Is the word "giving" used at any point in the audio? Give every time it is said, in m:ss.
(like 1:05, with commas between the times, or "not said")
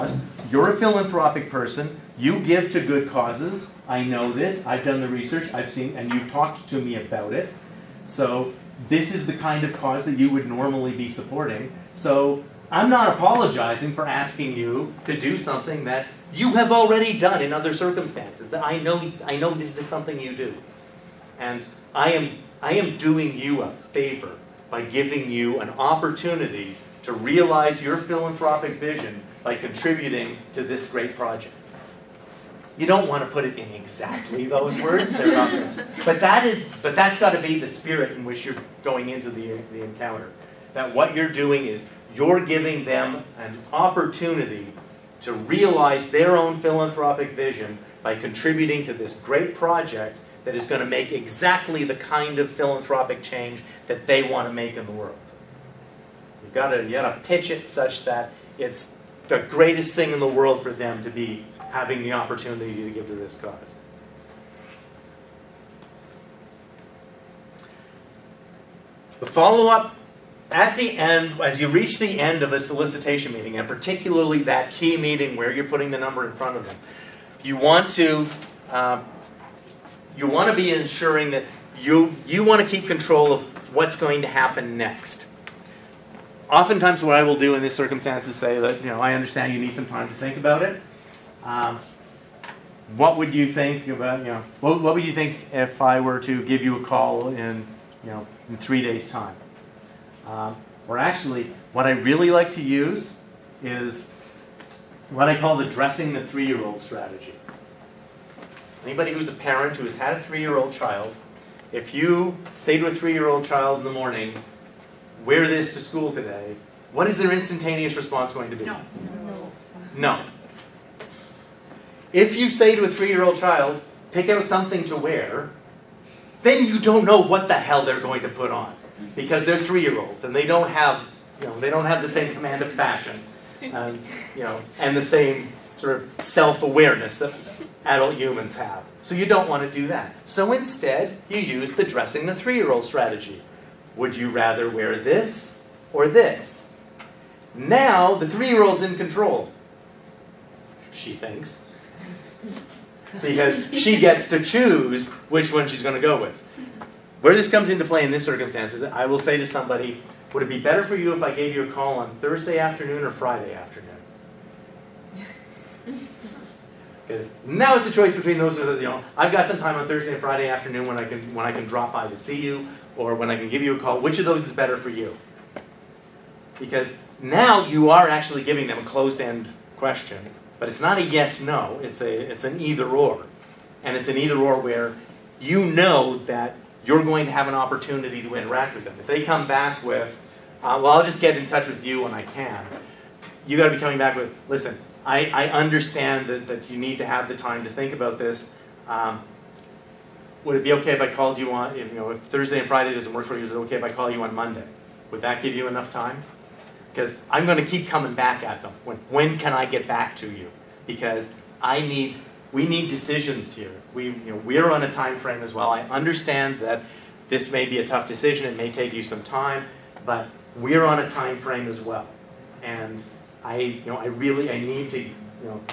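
0:24, 0:42, 2:58.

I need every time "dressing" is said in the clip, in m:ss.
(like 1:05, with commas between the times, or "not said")
1:45, 2:21.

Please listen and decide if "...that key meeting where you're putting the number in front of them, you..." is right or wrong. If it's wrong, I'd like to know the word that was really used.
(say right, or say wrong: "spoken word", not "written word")
right.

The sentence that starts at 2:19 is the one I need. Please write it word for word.
So you don't want to do that.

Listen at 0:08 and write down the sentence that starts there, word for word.
So this is the kind of cause that you would normally be supporting.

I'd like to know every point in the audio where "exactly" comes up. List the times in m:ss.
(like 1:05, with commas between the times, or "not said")
0:33, 0:51.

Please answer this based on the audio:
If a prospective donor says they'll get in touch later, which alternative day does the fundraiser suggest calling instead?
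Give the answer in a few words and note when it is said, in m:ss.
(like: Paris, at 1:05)
Monday, at 3:24.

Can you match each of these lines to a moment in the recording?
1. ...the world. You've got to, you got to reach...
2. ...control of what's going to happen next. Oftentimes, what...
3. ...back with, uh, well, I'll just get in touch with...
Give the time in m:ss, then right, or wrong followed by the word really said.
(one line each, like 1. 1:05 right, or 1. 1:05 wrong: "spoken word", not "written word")
1. 0:54 wrong: "pitch", not "reach"
2. 1:22 right
3. 3:09 right.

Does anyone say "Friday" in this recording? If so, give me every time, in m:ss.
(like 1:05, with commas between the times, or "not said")
2:43, 2:50, 3:22.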